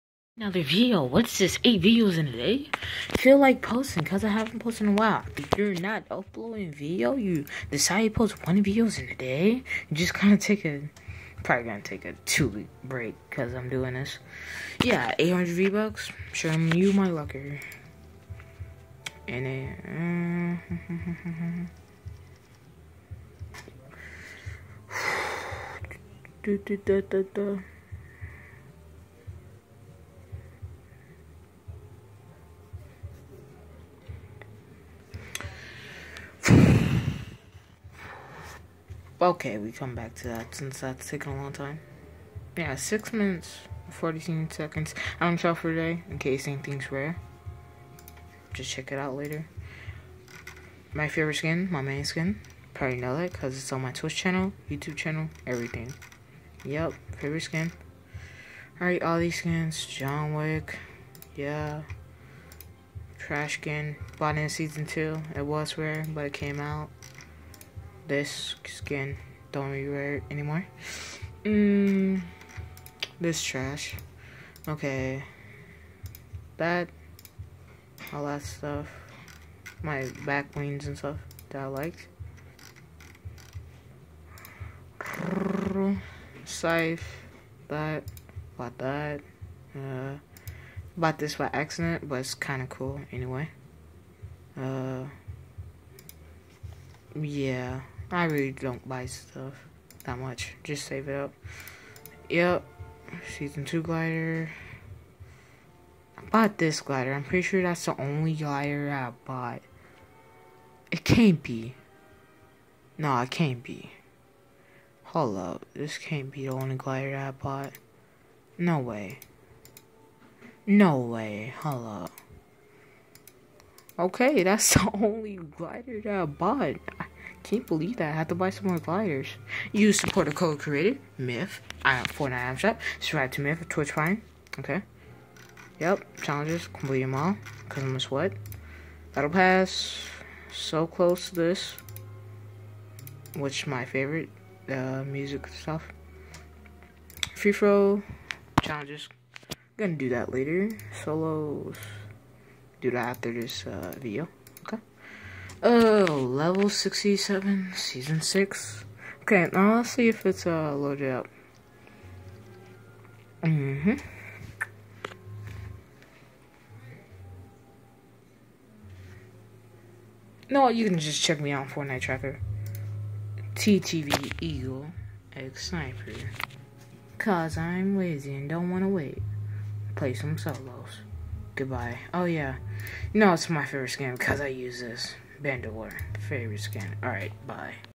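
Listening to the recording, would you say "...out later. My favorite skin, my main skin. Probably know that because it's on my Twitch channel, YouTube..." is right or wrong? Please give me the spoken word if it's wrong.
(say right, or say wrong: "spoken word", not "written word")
right.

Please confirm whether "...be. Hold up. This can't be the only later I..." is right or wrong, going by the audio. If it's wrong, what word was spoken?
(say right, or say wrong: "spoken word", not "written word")
wrong: "glider", not "later".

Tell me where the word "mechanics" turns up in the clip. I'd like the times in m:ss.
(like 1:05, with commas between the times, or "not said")
not said.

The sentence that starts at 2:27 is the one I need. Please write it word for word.
Free throw, challenges, gonna do that later.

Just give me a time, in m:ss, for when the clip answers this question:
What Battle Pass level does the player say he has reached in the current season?
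2:36.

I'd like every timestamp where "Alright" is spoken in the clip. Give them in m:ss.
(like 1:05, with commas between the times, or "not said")
0:58, 3:07.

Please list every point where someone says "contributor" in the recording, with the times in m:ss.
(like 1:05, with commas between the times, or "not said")
not said.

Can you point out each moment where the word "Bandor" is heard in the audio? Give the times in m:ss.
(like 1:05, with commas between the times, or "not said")
3:05.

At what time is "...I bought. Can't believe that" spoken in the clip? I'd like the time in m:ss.
2:06.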